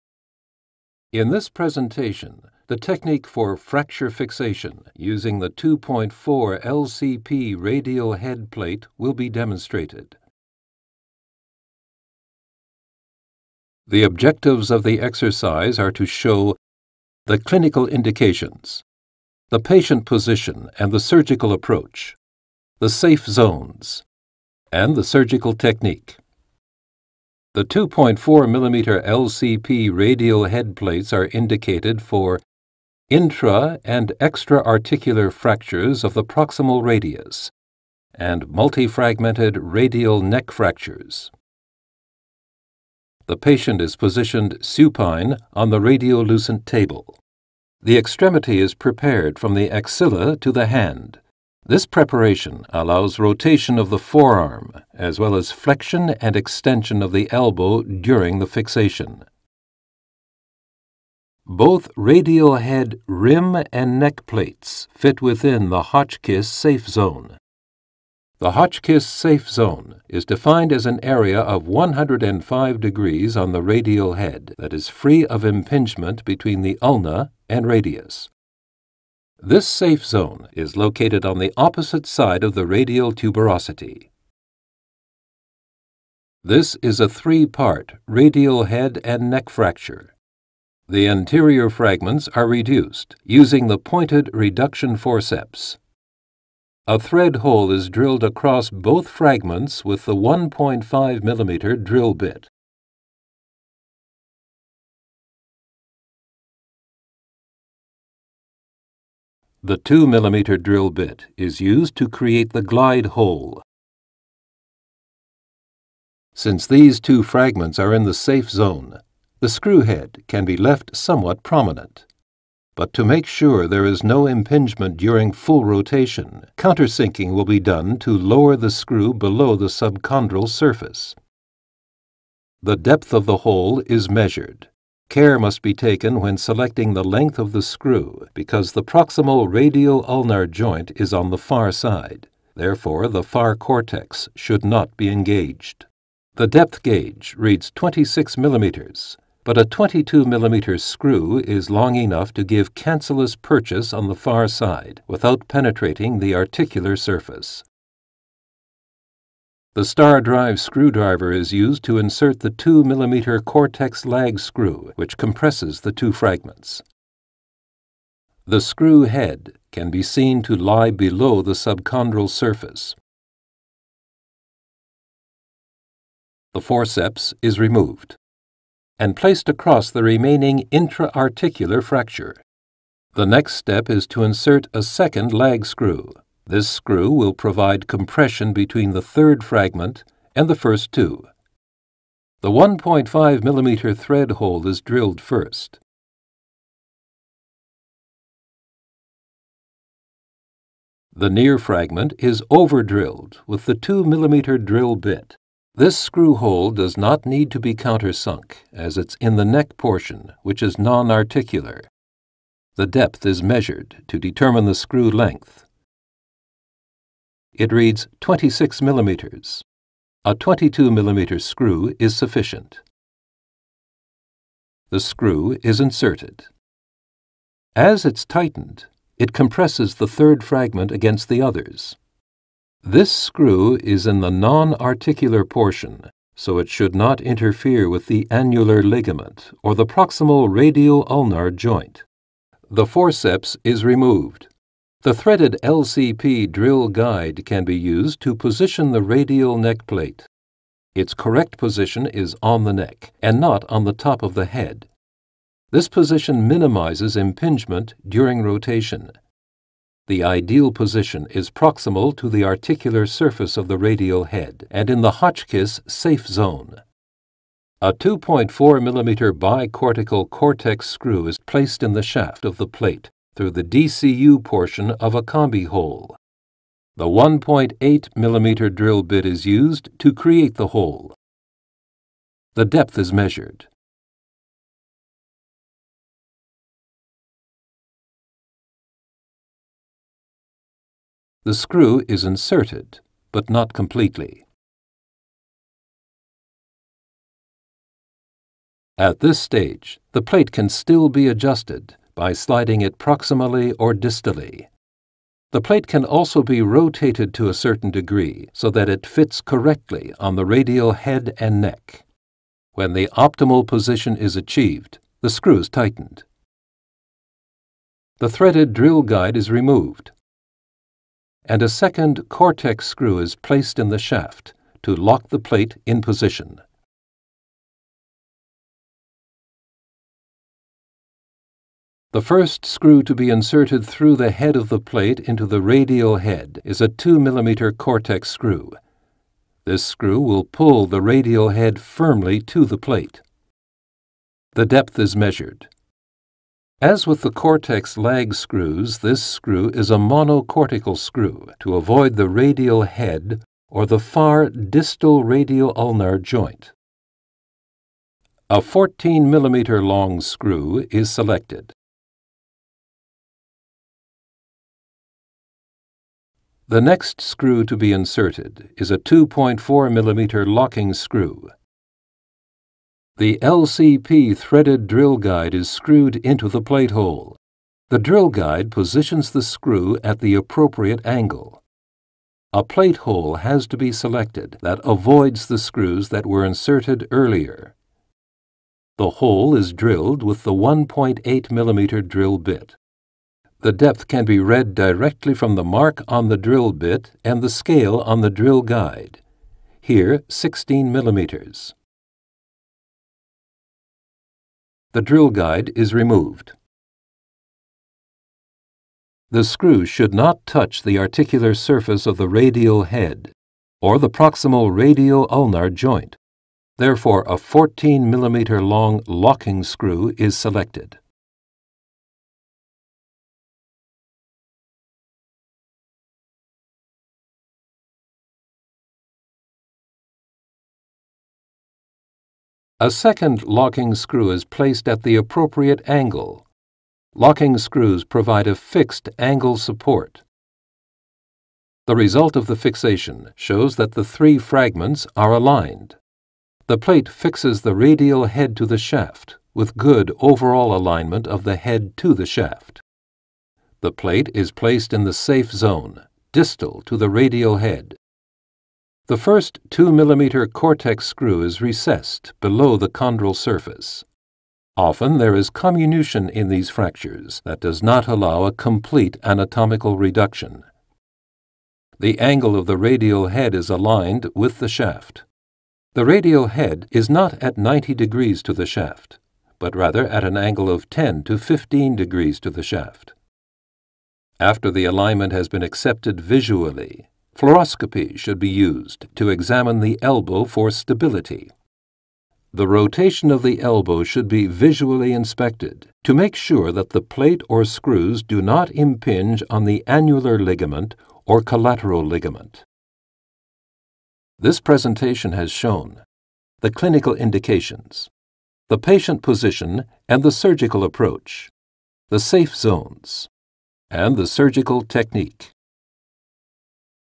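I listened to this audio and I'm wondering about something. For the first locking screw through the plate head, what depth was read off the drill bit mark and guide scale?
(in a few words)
16 millimeters.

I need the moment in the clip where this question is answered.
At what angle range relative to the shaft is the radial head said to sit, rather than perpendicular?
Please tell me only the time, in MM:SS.
08:00.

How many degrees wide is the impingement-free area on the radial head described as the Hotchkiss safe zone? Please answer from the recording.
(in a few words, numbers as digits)
105 degrees.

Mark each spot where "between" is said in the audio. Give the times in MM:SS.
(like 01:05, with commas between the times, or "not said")
01:16, 03:08.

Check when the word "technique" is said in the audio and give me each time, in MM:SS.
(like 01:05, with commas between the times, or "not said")
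00:02, 00:25, 08:34.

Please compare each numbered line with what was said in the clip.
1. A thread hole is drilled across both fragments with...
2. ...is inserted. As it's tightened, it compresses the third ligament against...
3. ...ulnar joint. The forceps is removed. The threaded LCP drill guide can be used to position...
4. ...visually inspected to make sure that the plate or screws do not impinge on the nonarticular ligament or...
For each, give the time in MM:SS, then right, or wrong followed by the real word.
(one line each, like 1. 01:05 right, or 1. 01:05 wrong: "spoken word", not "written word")
1. 01:36 right
2. 03:45 wrong: "fragment", not "ligament"
3. 04:01 right
4. 08:14 wrong: "annular", not "nonarticular".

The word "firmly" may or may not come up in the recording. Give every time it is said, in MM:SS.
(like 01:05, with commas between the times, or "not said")
05:41.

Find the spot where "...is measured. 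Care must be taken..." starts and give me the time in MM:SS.
02:13.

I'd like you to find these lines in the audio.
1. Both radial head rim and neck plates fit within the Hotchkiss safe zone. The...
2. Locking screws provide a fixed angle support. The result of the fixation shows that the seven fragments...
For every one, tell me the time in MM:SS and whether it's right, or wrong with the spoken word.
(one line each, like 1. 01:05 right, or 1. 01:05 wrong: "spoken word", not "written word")
1. 01:01 right
2. 07:17 wrong: "three", not "seven".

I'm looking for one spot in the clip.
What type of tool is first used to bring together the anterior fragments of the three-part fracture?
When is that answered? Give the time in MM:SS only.
01:33.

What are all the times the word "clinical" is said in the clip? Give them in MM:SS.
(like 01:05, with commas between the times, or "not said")
00:17, 08:26.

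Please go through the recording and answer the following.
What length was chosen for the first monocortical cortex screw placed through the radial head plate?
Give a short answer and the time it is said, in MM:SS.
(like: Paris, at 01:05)
14 mm, at 05:58.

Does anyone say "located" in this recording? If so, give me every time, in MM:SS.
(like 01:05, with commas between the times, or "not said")
01:20.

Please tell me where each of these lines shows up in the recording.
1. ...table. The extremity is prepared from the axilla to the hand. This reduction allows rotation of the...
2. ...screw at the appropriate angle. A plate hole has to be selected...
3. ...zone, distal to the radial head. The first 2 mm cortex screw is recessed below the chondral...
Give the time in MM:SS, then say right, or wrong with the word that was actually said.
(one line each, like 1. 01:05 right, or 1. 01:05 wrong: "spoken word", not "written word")
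1. 00:46 wrong: "preparation", not "reduction"
2. 06:19 right
3. 07:35 right.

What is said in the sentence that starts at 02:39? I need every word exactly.
The star drive screwdriver is used to insert the 2 mm cortex lag screw, which compresses the two fragments.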